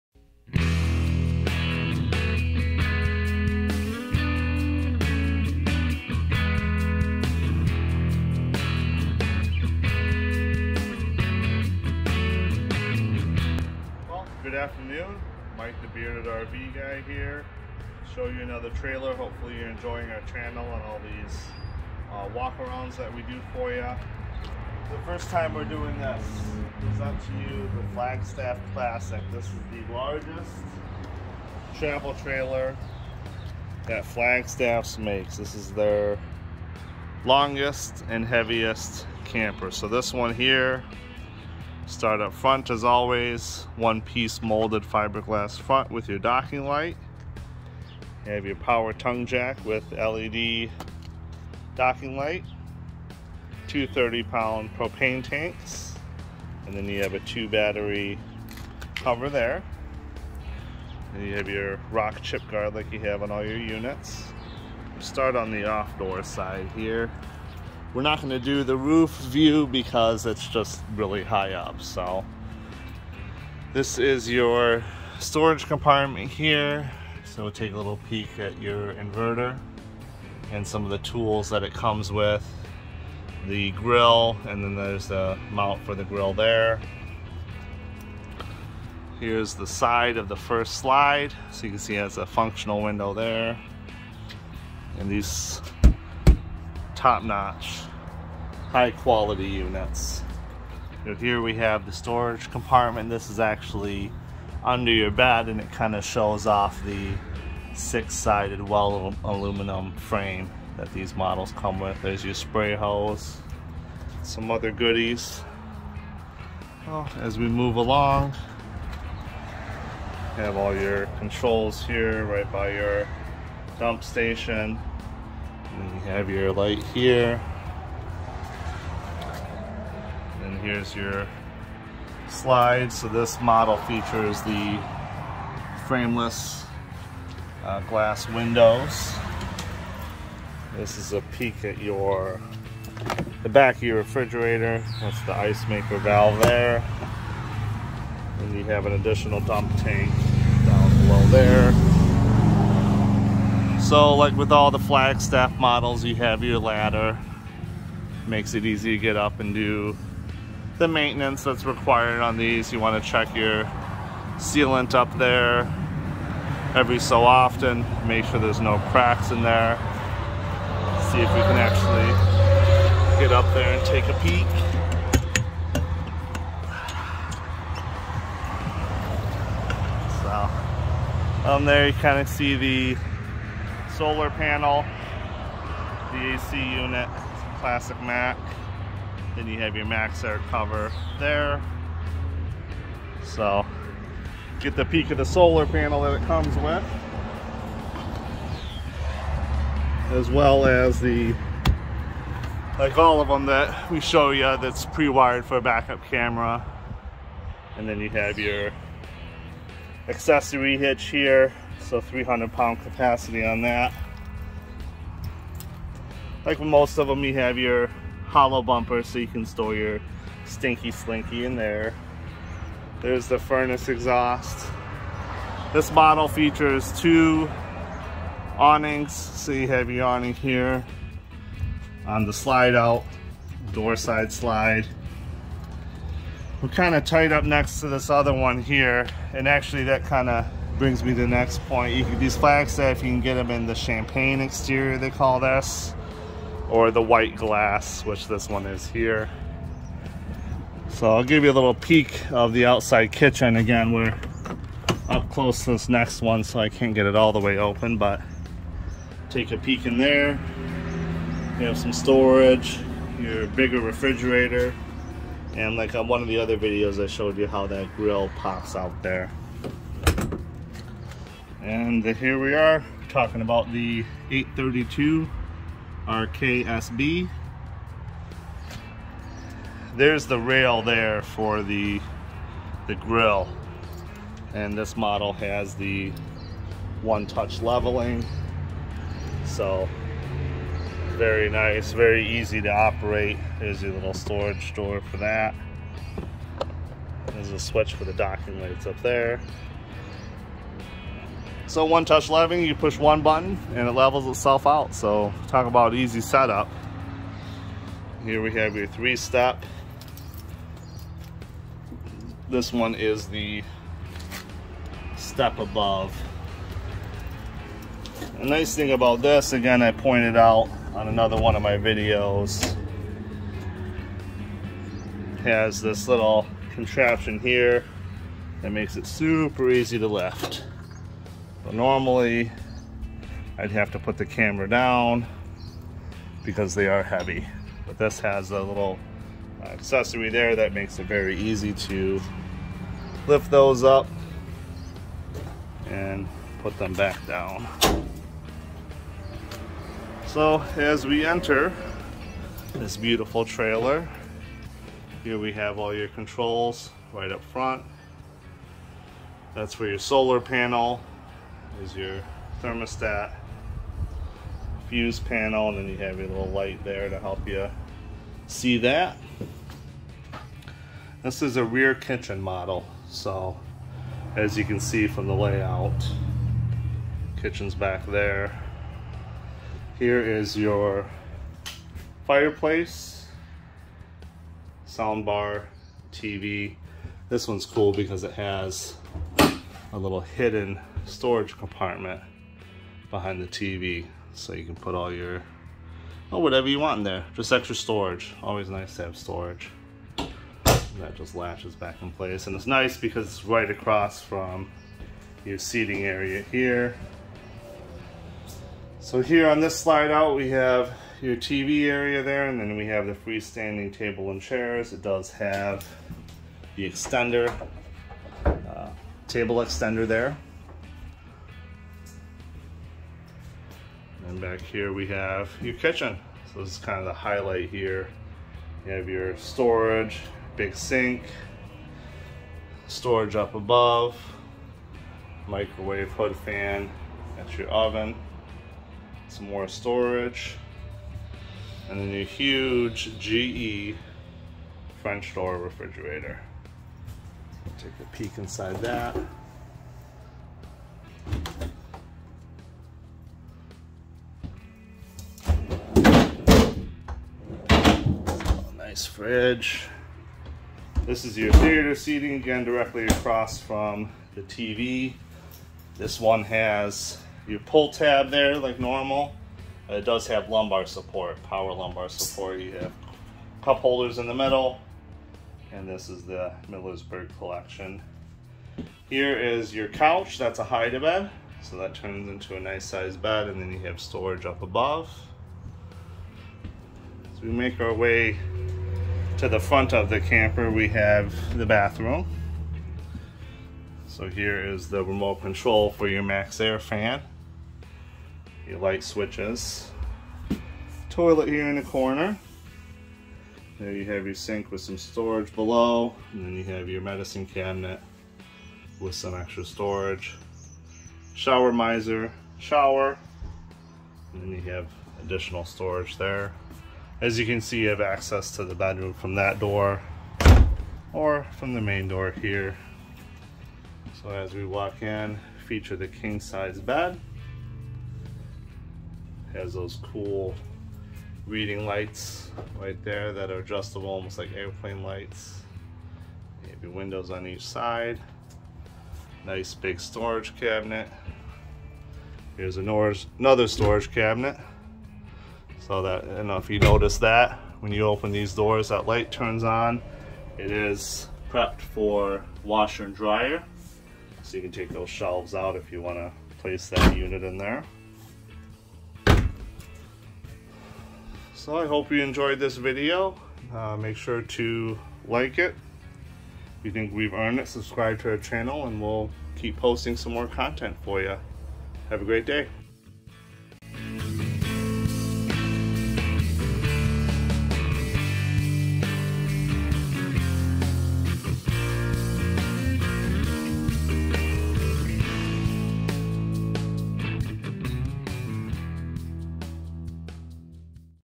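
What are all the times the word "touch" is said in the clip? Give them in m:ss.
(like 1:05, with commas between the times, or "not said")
4:47, 5:02.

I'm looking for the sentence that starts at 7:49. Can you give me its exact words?
Uh, it does have lumbar support, power lumbar support.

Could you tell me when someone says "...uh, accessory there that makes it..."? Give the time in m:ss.
5:39.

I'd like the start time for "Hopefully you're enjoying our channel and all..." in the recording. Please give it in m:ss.
0:19.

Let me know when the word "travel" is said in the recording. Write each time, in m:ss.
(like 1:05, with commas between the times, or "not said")
0:31.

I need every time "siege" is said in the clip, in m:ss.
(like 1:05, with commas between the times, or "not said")
not said.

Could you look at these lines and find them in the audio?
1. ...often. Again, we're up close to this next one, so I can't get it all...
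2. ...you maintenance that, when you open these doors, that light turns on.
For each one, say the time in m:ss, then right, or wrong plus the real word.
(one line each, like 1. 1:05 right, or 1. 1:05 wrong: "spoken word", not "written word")
1. 4:13 wrong: "kitchen", not "often"
2. 9:06 wrong: "notice", not "maintenance".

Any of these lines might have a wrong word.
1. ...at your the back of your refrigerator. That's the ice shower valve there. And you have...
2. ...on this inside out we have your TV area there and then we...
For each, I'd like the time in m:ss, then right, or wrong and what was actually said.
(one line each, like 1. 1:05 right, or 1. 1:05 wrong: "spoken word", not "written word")
1. 2:21 wrong: "maker", not "shower"
2. 6:49 wrong: "slide", not "inside".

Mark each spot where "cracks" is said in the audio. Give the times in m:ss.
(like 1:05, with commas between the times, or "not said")
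2:48.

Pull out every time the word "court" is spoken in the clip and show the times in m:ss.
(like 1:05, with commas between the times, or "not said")
not said.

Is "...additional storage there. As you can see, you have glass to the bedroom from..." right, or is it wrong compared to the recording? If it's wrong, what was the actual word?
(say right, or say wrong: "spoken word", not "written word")
wrong: "access", not "glass".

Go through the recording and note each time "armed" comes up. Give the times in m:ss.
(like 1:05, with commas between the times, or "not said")
not said.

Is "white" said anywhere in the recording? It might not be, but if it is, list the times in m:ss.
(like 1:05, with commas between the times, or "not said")
4:07.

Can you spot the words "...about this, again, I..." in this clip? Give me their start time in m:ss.
5:18.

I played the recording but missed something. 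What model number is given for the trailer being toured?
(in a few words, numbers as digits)
832 RKSB.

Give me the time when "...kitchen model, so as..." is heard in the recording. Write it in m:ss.
6:11.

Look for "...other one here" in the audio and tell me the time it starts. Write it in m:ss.
3:58.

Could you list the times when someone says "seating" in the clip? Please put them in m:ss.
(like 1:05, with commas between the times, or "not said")
6:45, 7:41.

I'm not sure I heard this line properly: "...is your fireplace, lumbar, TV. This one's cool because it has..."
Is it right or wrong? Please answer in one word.
wrong.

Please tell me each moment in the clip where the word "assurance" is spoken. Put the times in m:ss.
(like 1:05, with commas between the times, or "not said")
not said.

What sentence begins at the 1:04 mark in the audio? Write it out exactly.
Start on the off door side here.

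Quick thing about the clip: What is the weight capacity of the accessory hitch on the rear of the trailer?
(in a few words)
300 pounds.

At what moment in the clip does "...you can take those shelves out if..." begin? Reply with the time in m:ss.
9:14.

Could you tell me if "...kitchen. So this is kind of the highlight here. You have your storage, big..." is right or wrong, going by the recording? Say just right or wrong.
right.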